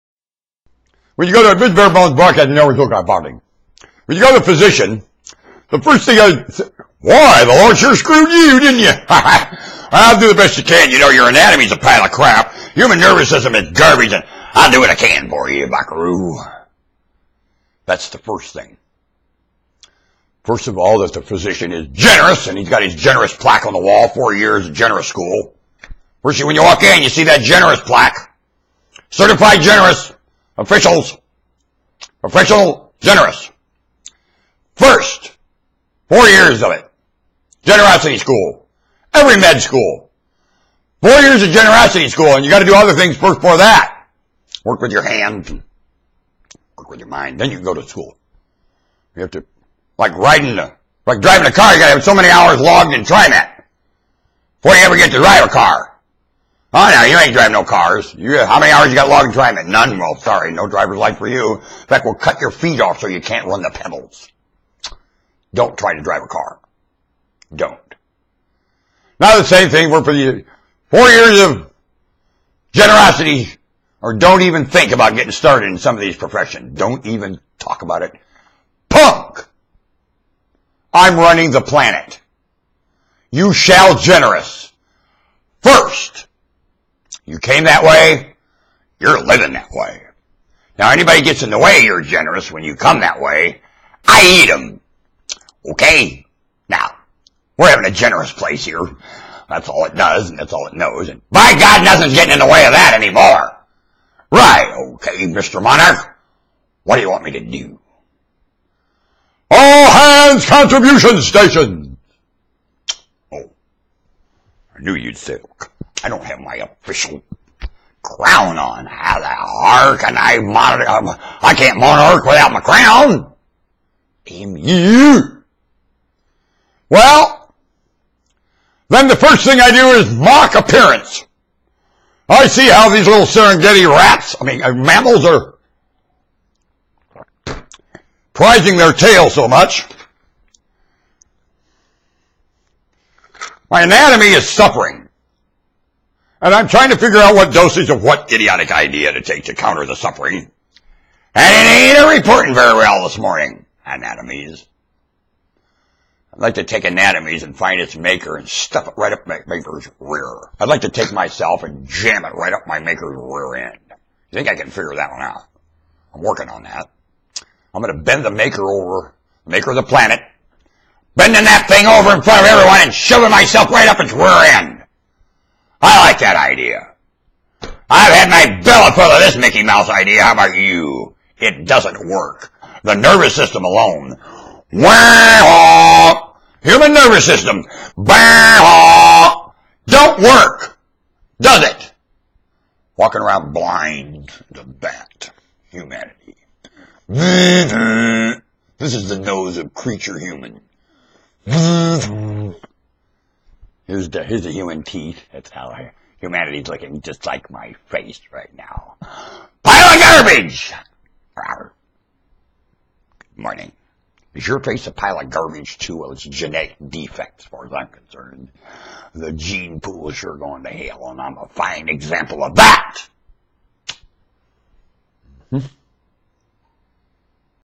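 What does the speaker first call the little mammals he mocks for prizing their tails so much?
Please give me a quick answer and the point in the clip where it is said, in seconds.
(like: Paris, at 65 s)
Serengeti rats, at 133 s.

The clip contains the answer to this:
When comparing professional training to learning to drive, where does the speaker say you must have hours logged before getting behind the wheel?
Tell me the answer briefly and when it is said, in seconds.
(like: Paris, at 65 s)
TriMet, at 53 s.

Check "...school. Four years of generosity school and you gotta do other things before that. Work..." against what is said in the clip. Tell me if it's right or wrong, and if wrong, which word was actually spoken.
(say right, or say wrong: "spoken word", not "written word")
right.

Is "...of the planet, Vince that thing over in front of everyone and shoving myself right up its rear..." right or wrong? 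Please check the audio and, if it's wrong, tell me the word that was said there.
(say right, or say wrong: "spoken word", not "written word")
wrong: "Bending", not "Vince".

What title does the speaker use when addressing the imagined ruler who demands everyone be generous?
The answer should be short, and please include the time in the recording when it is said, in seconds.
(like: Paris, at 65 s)
Mr. Monarch, at 105 s.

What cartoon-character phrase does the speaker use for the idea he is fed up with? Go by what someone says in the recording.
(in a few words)
Mickey Mouse idea.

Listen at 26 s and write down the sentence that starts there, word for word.
First, when you walk in, you see that generous plaque.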